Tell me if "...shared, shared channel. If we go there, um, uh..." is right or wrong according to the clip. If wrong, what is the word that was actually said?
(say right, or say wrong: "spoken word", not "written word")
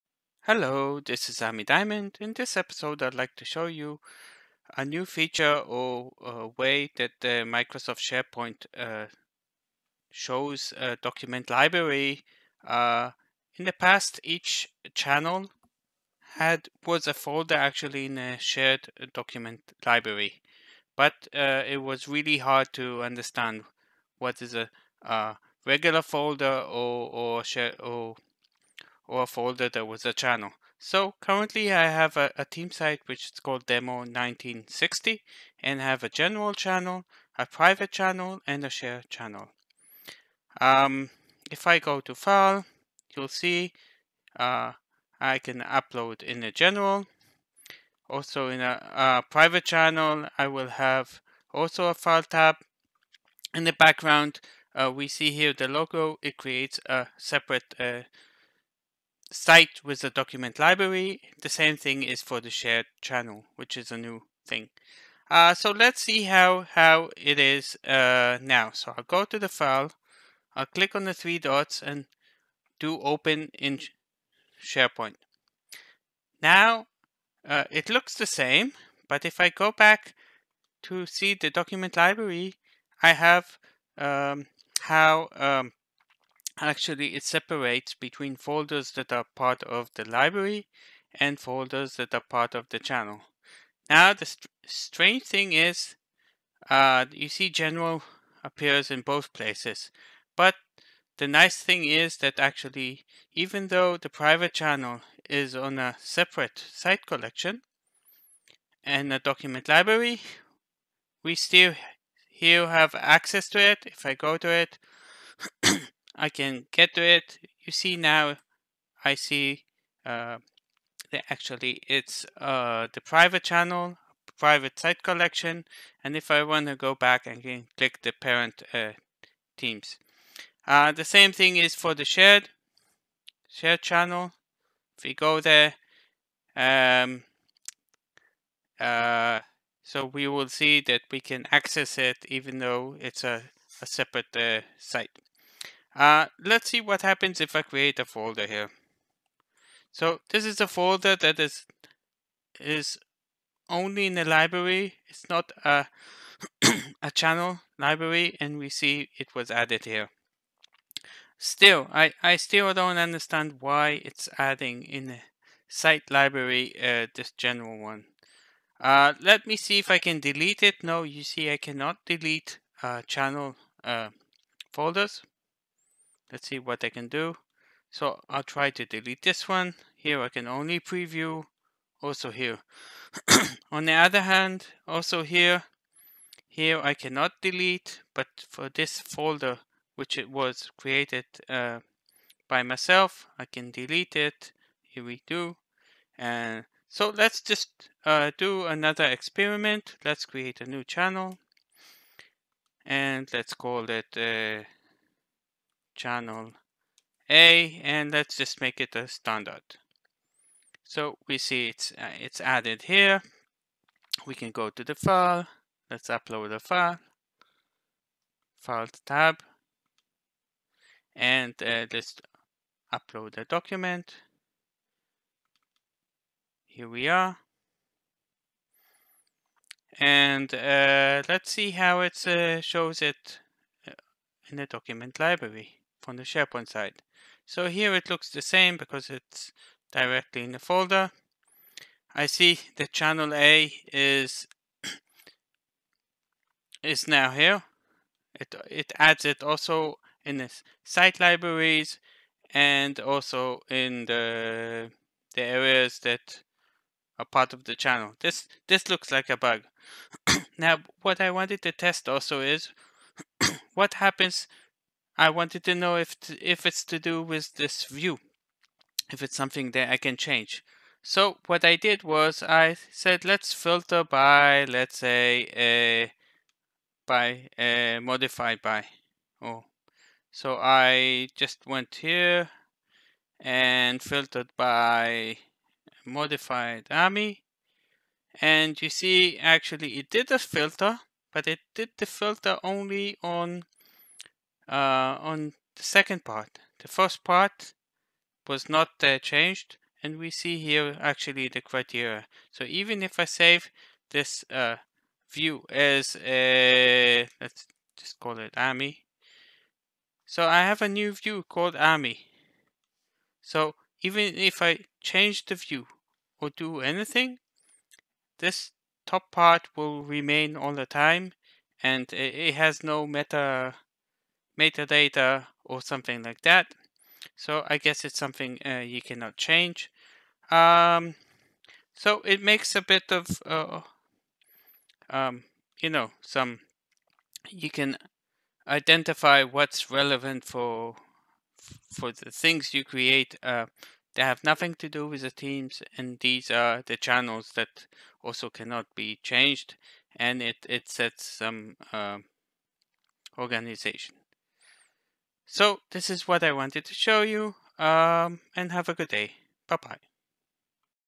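right.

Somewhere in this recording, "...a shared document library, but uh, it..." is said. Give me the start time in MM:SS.
00:18.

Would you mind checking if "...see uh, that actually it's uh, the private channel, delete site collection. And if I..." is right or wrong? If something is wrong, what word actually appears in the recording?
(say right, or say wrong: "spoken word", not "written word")
wrong: "private", not "delete".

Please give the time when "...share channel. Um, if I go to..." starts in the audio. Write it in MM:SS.
00:38.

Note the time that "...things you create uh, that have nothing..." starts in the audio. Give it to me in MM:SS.
05:42.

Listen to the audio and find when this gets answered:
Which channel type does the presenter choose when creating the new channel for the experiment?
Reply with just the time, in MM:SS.
03:29.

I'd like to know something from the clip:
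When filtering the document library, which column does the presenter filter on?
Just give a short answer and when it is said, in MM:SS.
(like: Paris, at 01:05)
modified, at 04:46.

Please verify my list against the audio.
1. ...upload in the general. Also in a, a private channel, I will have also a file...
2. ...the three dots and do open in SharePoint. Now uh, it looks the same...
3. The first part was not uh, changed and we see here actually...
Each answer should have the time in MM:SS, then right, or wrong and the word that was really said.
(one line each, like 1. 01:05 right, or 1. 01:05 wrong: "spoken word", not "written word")
1. 00:45 right
2. 01:11 right
3. 04:56 right.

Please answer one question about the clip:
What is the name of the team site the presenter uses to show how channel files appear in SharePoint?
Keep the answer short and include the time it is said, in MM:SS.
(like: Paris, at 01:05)
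demo 1960, at 00:33.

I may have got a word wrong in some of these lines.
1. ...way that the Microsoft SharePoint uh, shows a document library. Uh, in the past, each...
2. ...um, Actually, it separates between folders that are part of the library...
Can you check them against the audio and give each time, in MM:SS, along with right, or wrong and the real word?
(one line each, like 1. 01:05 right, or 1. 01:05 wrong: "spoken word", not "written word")
1. 00:06 right
2. 01:25 right.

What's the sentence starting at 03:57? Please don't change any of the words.
So here it looks the same because it's directly in the folder.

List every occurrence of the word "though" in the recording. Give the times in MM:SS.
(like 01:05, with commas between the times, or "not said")
01:43, 02:22.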